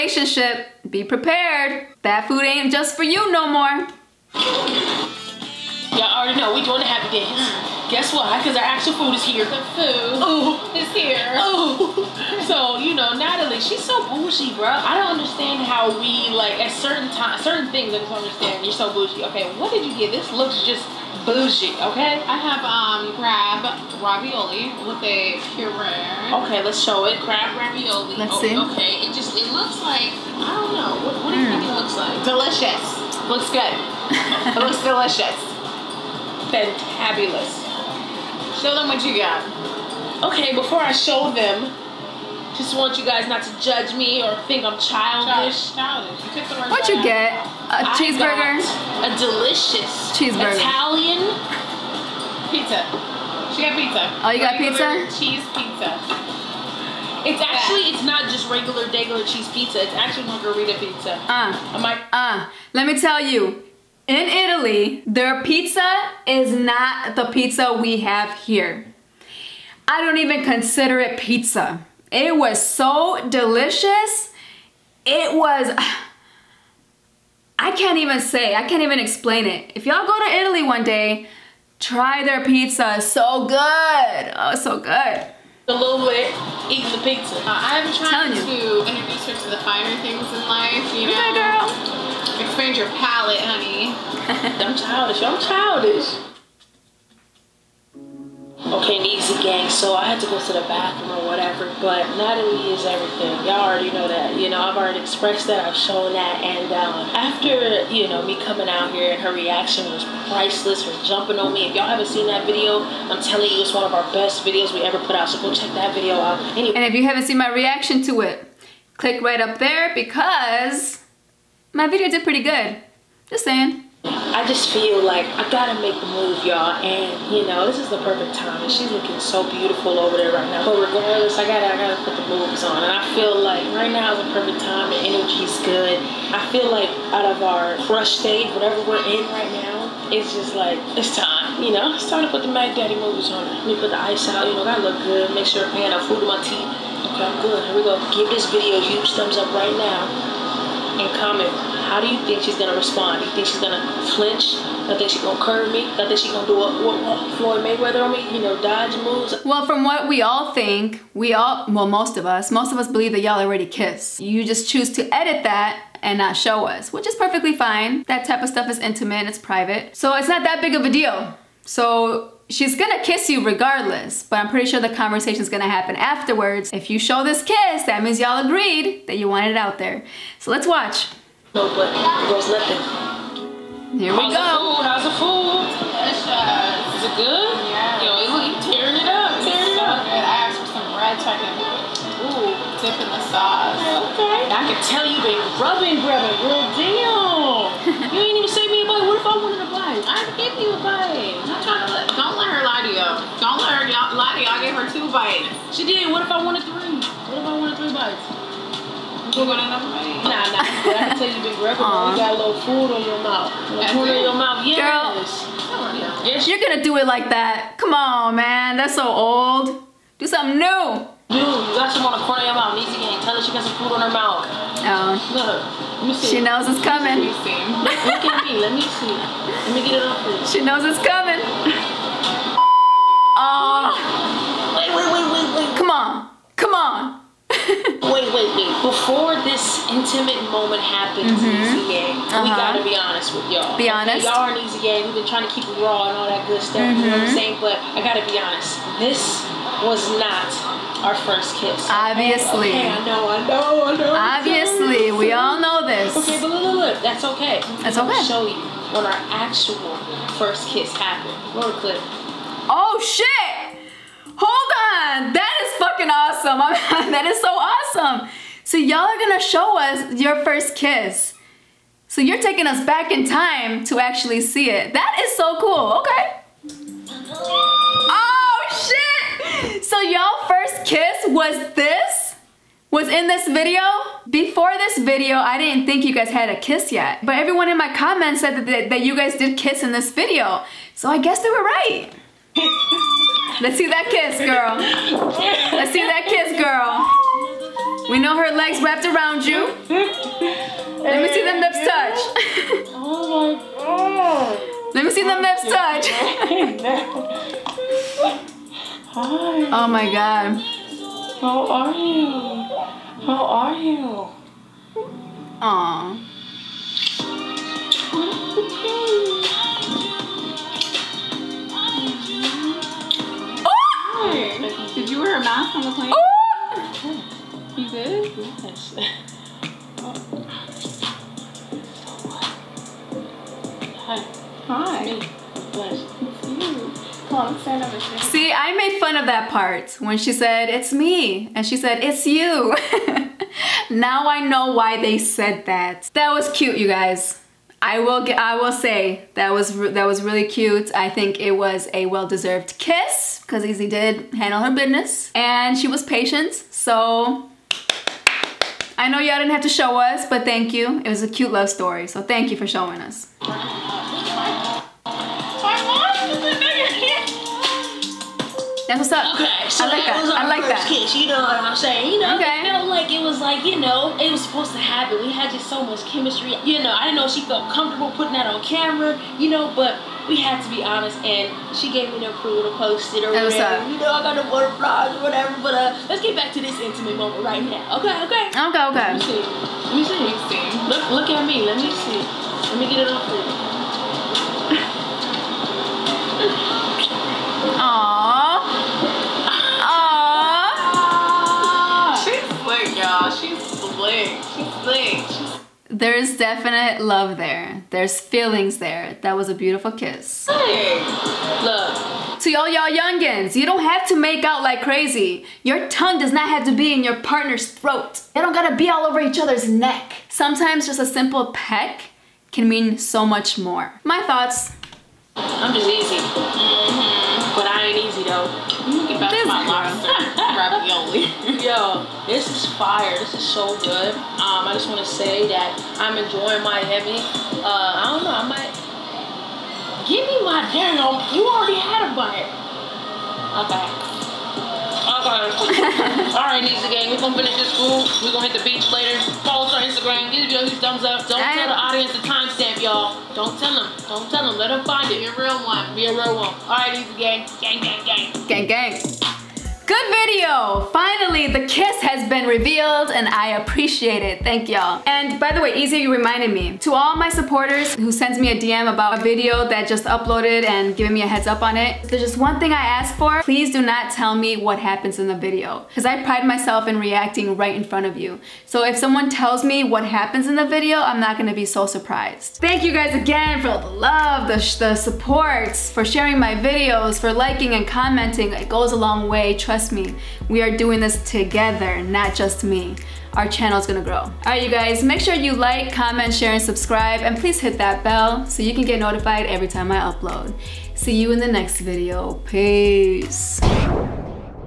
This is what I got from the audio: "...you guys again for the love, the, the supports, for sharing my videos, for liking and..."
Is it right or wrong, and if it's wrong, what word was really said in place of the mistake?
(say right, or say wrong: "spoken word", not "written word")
right.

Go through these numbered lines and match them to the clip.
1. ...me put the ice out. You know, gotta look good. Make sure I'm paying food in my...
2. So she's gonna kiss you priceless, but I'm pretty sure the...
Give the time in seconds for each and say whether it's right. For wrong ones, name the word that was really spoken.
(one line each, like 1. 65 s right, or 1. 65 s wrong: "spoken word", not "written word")
1. 143 s right
2. 171 s wrong: "regardless", not "priceless".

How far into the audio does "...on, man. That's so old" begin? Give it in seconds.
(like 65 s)
217 s.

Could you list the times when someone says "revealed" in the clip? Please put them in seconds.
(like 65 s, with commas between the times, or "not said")
462 s.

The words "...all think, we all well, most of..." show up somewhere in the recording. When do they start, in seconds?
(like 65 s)
160 s.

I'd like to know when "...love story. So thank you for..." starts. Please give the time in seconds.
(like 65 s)
361 s.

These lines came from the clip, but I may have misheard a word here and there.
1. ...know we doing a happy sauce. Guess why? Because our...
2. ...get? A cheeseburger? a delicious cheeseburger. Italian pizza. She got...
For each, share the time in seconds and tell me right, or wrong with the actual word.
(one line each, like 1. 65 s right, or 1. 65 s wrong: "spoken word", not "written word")
1. 6 s wrong: "dance", not "sauce"
2. 47 s right.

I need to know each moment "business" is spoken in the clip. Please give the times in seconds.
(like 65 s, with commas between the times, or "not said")
354 s.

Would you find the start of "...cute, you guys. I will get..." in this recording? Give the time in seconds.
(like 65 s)
346 s.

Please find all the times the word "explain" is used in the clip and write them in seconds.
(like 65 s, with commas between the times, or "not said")
78 s.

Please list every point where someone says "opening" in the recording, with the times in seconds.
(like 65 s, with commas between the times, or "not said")
not said.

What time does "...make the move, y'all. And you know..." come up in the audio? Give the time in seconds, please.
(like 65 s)
125 s.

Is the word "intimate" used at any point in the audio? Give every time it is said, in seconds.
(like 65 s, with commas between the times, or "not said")
168 s, 239 s, 386 s.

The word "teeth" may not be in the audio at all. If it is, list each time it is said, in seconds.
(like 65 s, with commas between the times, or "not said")
146 s.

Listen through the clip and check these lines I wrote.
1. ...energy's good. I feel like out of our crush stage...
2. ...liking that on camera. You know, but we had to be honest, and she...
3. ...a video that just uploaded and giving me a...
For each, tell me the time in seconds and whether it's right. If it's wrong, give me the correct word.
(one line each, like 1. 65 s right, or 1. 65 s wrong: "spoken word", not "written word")
1. 135 s right
2. 378 s wrong: "putting", not "liking"
3. 469 s right.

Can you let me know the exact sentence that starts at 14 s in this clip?
I don't understand how we like at certain times, certain things.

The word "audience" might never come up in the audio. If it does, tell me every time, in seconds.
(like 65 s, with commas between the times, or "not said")
451 s.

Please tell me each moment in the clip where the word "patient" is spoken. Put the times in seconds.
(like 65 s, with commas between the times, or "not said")
356 s.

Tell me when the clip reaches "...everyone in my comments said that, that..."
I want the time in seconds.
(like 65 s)
287 s.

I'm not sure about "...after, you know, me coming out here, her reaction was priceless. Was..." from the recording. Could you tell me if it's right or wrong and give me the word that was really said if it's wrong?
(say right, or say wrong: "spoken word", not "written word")
right.